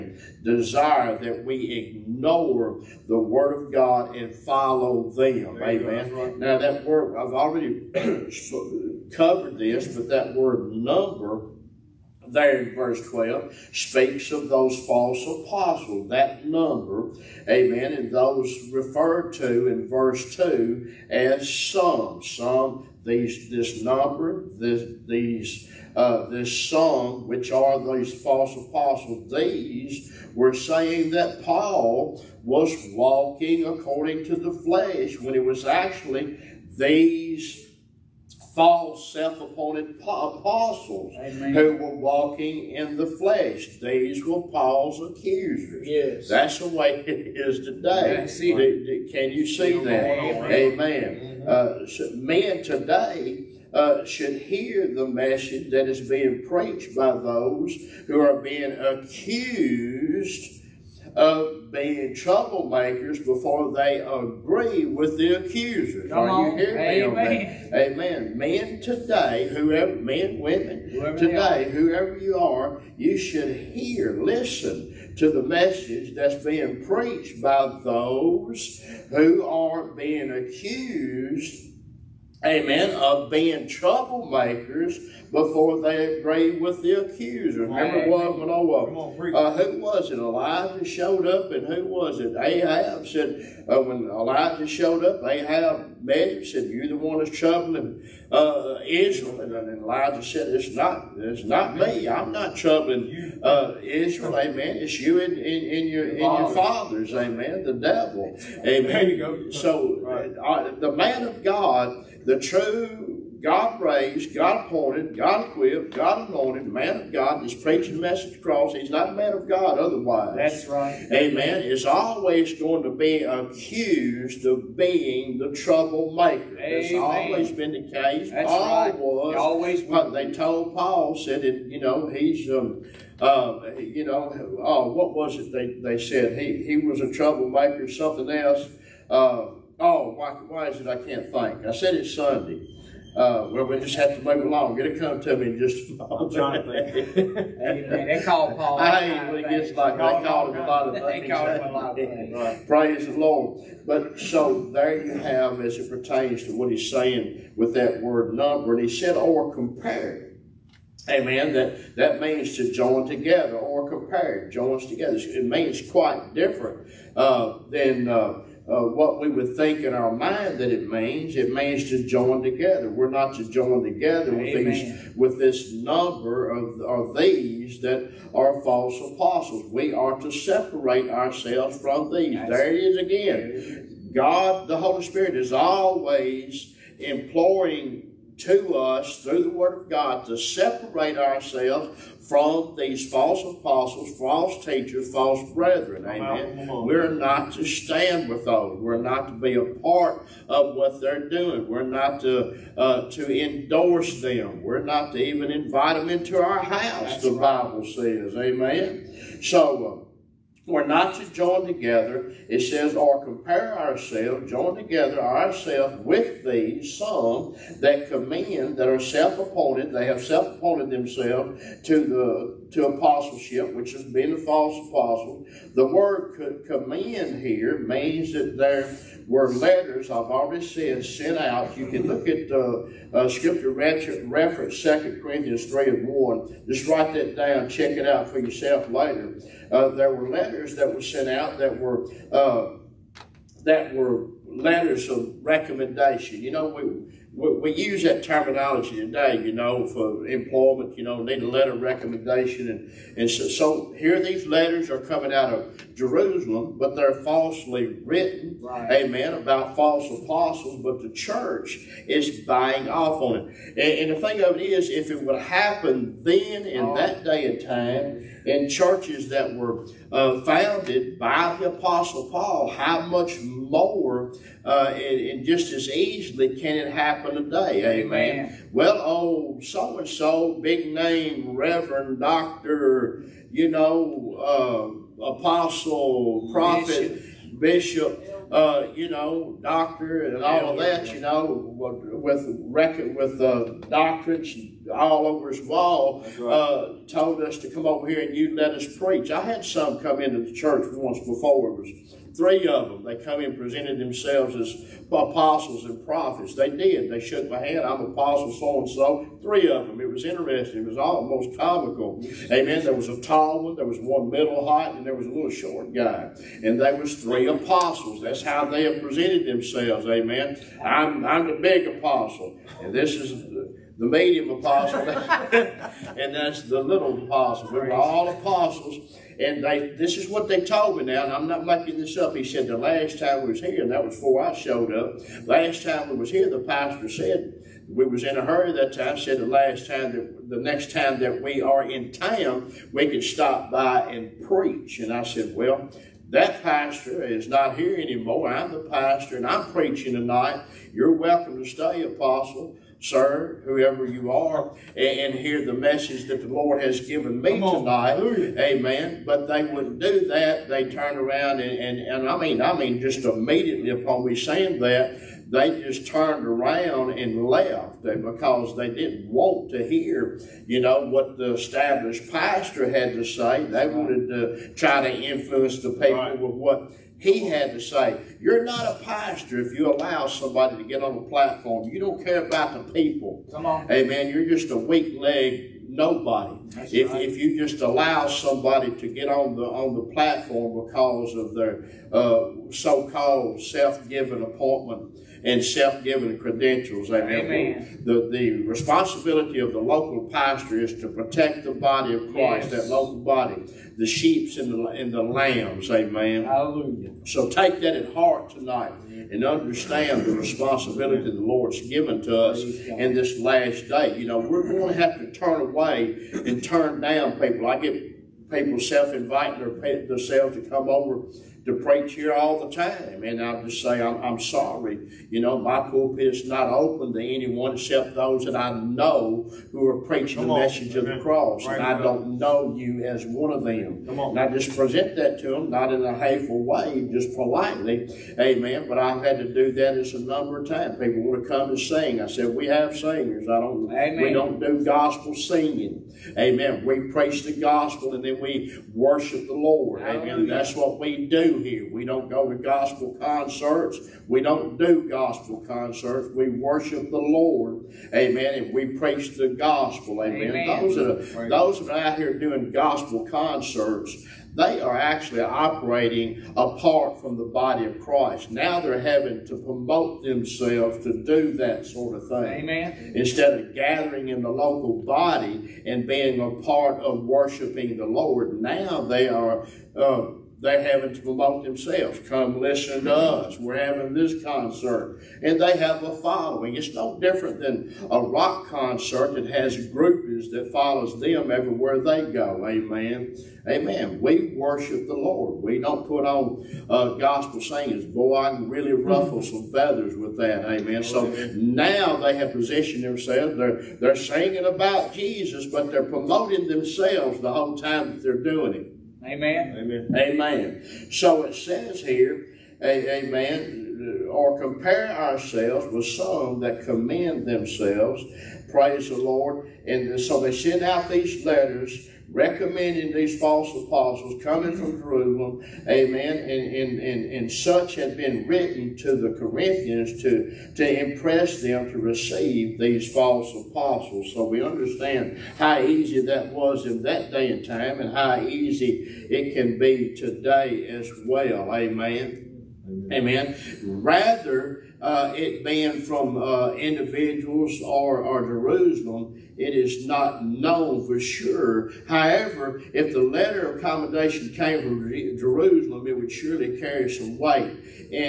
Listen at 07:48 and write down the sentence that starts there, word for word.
Now they're having to promote themselves to do that sort of thing.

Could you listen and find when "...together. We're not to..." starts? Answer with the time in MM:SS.
02:52.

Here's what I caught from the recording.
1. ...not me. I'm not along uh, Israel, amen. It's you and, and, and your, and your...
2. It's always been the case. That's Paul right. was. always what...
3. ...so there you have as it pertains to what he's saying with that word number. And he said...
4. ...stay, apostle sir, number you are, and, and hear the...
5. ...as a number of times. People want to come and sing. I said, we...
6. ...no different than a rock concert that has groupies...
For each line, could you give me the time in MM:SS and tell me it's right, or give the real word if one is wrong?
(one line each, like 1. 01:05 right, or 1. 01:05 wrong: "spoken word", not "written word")
1. 01:41 wrong: "troubling", not "along"
2. 02:06 right
3. 02:34 right
4. 05:51 wrong: "whoever", not "number"
5. 07:19 right
6. 08:06 right.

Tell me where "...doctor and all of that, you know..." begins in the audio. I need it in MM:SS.
04:49.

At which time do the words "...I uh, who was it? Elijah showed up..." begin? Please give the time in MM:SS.
01:28.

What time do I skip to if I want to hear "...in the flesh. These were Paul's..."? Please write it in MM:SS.
00:42.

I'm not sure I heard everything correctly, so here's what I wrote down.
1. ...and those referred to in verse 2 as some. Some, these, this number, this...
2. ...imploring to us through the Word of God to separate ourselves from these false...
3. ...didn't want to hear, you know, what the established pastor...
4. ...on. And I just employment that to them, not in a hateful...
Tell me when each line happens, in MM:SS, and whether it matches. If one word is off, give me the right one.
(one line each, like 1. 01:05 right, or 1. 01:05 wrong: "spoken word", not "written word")
1. 00:17 right
2. 03:06 right
3. 06:08 right
4. 07:14 wrong: "present", not "employment".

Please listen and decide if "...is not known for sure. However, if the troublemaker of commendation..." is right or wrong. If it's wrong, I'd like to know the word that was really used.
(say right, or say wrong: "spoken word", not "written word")
wrong: "letter", not "troublemaker".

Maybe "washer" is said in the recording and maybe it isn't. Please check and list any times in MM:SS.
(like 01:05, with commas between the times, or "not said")
not said.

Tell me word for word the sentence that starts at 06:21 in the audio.
You don't care about the people.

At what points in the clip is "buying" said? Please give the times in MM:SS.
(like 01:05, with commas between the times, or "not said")
04:22.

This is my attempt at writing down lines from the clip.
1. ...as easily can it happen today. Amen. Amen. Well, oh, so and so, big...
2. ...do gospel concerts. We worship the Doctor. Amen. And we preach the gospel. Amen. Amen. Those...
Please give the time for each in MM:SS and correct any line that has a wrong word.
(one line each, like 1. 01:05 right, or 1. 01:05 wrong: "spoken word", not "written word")
1. 04:35 right
2. 07:34 wrong: "Lord", not "Doctor".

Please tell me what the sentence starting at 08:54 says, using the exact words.
So we understand how easy that was in that day and time and how easy it can be today as well, amen.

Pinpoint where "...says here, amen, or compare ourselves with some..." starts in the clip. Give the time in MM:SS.
08:31.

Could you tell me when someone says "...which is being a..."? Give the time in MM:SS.
03:43.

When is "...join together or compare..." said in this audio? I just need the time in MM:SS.
02:42.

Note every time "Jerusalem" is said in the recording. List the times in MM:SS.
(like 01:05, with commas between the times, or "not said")
04:15, 08:44, 09:08, 09:15.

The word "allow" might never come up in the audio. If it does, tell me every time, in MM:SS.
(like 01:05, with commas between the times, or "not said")
06:19, 06:27.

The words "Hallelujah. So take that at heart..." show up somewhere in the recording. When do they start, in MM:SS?
06:46.